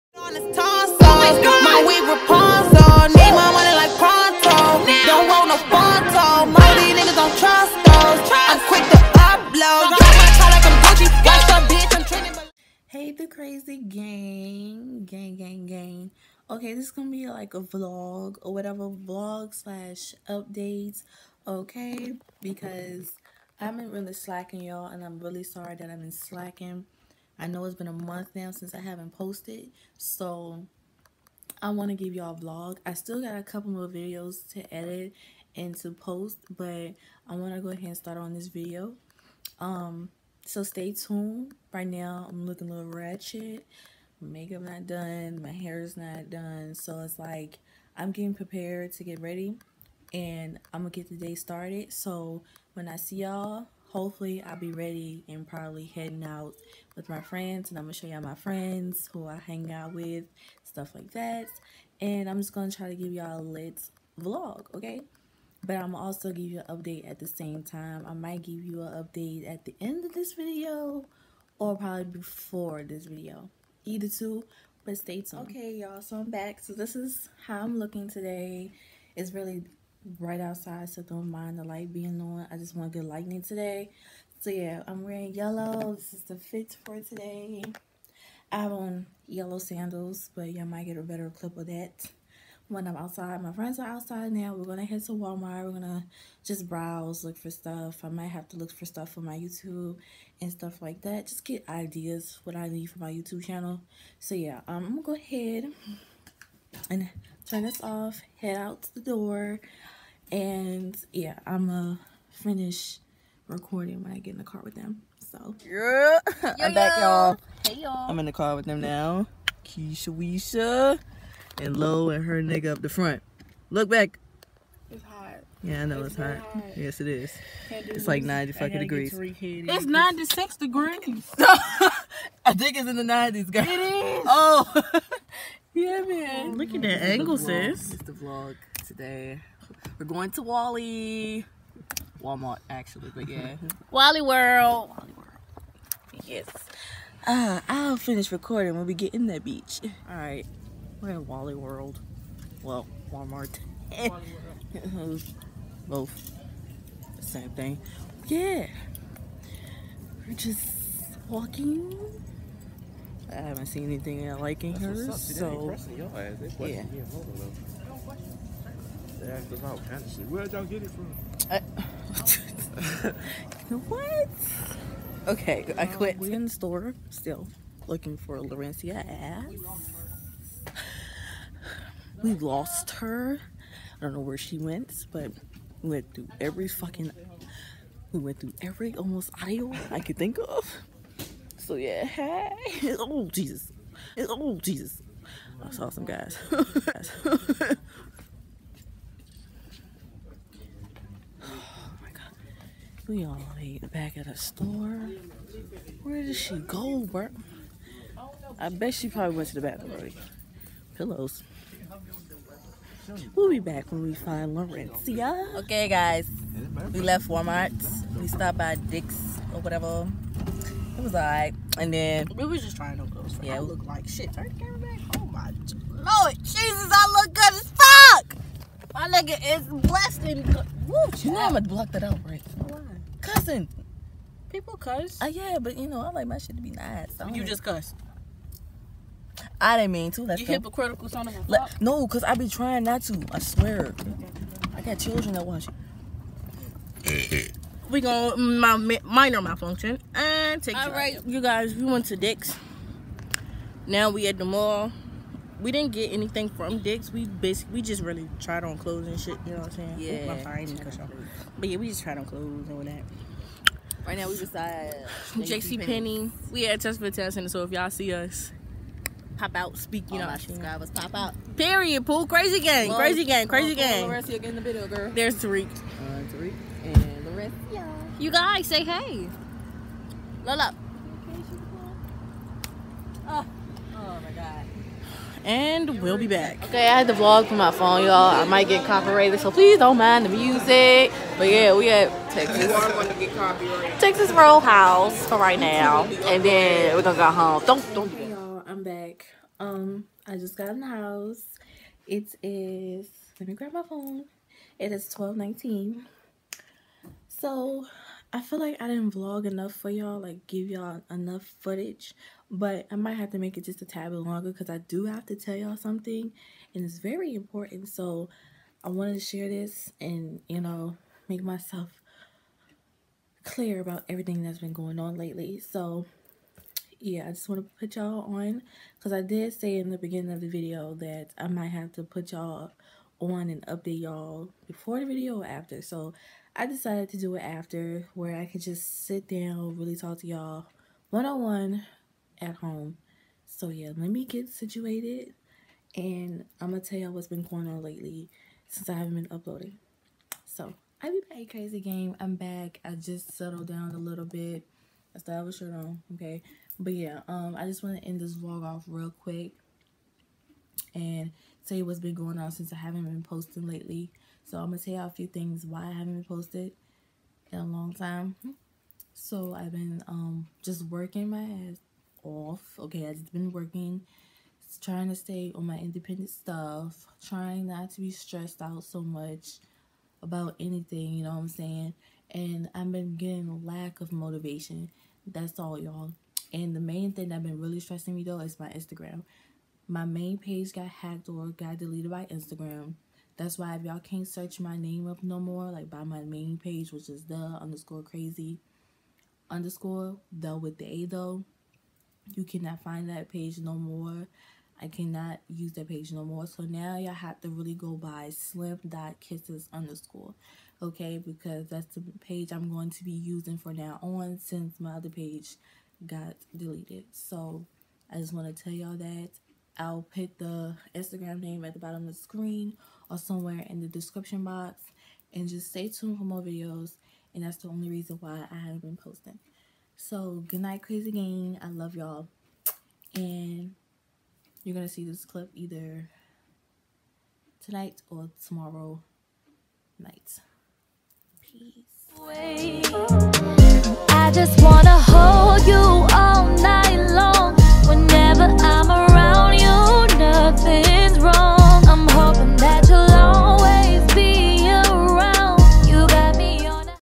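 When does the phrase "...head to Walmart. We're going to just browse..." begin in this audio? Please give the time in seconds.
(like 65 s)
94 s.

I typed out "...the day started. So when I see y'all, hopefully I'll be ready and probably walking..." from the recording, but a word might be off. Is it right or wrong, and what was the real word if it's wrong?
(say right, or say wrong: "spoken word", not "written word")
wrong: "heading", not "walking".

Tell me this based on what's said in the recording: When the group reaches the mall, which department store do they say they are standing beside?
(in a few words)
JCPenney.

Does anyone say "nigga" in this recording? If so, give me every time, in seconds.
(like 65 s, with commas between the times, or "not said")
122 s, 229 s.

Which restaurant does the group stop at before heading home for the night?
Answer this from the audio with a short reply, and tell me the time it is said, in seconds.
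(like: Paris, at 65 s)
Texas Roadhouse, at 293 s.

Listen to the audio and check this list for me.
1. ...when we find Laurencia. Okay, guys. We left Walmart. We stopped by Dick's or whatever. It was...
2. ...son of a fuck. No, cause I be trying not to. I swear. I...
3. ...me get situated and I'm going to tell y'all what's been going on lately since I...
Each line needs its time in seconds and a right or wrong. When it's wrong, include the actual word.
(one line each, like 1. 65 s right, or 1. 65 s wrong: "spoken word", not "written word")
1. 213 s right
2. 241 s right
3. 344 s right.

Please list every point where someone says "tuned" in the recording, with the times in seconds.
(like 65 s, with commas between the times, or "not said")
40 s, 75 s, 425 s.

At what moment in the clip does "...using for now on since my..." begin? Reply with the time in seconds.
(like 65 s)
413 s.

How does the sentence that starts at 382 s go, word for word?
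And I've been getting a lack of motivation.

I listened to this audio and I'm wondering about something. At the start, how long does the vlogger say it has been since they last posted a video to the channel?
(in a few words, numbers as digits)
a month.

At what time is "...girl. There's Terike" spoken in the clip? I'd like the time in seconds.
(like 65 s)
274 s.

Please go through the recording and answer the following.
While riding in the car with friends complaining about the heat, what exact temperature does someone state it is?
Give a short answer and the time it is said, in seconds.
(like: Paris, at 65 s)
96 degrees, at 129 s.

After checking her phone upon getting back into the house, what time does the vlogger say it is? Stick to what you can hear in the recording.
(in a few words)
12:19.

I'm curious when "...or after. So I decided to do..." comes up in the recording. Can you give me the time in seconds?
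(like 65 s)
335 s.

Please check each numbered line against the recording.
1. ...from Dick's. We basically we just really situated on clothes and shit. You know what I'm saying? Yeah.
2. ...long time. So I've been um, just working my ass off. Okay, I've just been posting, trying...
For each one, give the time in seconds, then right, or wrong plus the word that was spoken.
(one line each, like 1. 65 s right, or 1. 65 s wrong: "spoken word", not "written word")
1. 256 s wrong: "tried", not "situated"
2. 367 s wrong: "working", not "posting".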